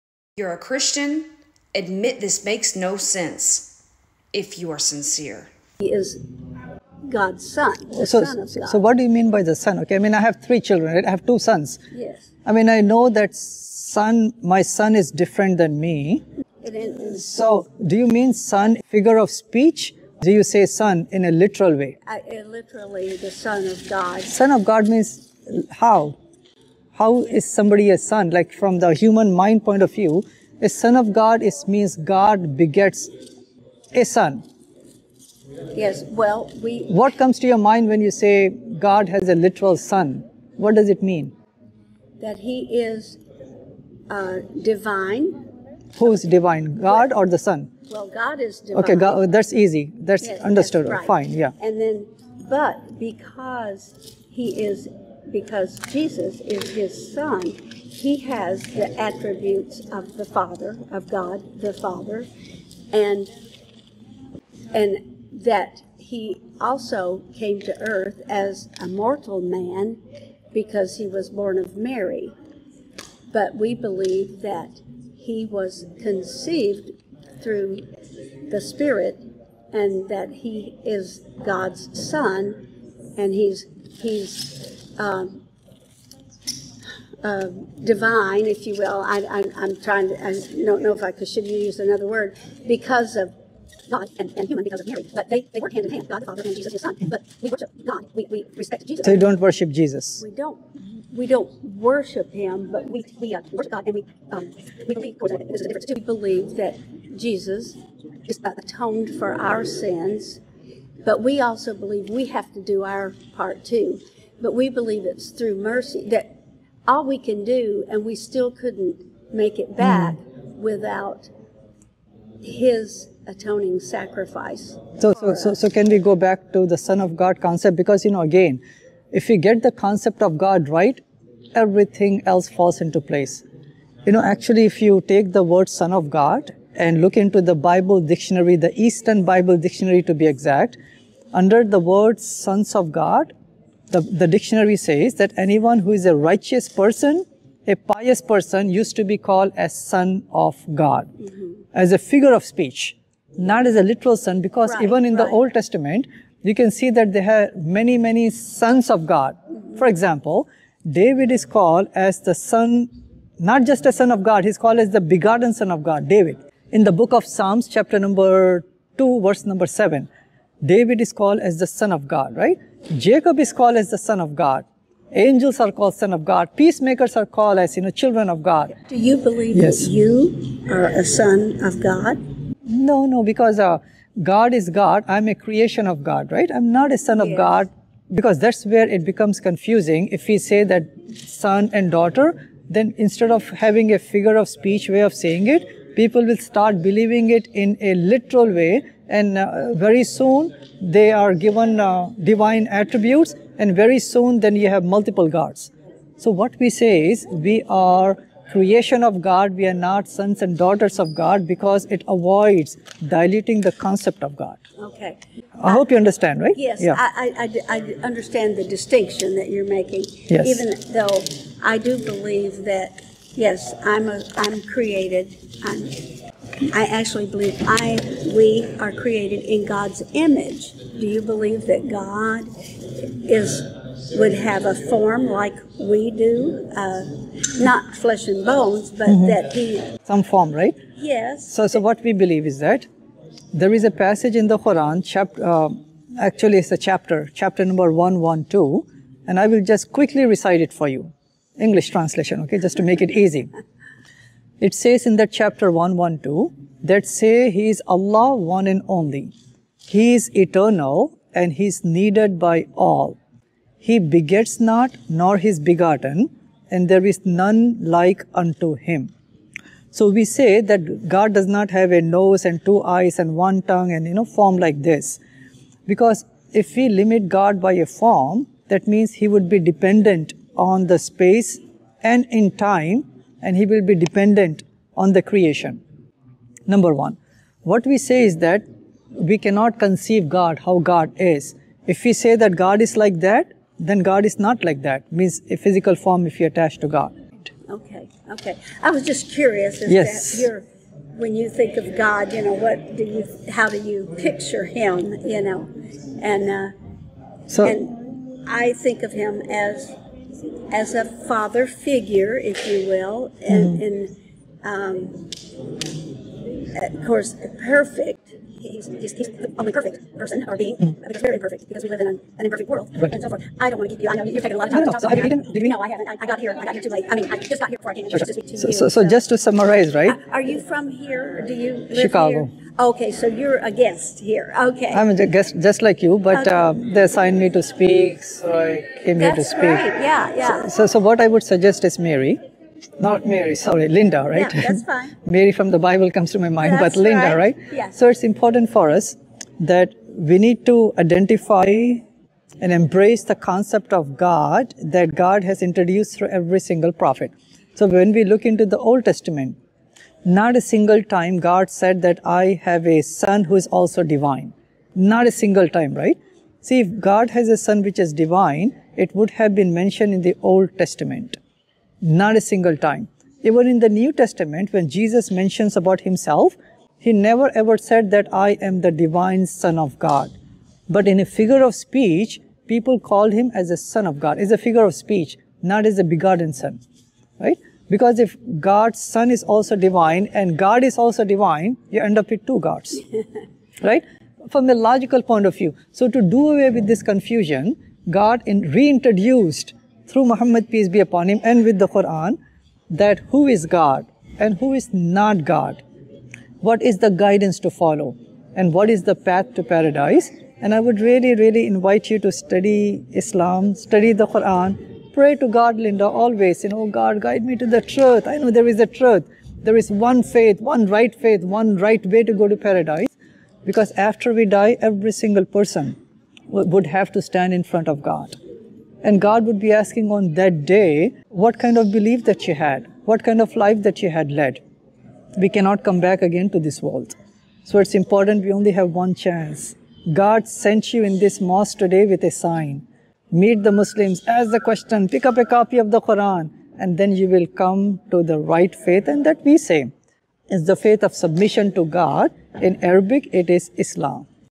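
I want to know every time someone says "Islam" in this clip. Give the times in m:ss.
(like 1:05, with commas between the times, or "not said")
6:53, 7:33.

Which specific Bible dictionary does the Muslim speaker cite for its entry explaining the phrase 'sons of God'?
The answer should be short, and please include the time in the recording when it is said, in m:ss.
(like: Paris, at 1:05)
Easton Bible dictionary, at 2:18.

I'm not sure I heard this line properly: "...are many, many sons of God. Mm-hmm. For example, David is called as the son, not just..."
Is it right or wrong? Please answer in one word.
right.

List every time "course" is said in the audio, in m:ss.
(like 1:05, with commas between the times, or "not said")
1:45, 5:17.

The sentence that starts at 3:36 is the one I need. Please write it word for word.
I, I, I understand the distinction that you're making yes.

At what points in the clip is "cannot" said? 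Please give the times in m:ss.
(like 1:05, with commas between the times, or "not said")
4:49, 7:15.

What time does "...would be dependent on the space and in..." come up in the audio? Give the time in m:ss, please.
4:39.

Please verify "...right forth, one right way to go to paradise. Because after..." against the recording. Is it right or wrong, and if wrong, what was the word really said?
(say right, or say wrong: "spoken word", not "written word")
wrong: "faith", not "forth".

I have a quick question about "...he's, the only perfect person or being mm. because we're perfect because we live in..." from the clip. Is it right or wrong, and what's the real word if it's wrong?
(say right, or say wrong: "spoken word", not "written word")
wrong: "imperfect", not "perfect".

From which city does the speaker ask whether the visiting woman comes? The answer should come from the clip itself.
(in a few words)
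Chicago.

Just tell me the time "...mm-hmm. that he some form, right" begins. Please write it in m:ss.
3:59.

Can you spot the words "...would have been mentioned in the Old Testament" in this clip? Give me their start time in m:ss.
6:09.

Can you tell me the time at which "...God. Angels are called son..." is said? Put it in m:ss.
2:54.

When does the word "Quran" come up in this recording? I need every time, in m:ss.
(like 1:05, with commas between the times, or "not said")
4:04, 6:41, 6:54, 7:26.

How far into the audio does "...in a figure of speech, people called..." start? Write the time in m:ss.
6:21.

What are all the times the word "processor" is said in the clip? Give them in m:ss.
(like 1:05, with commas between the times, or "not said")
not said.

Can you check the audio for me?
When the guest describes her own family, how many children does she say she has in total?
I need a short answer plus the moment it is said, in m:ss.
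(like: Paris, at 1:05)
3, at 0:10.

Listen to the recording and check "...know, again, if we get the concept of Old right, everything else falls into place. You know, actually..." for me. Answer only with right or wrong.
wrong.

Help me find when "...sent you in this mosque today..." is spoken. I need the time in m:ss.
7:20.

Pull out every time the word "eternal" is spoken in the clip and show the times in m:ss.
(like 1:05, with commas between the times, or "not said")
4:20.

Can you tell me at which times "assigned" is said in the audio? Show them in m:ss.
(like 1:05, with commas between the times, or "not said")
5:37.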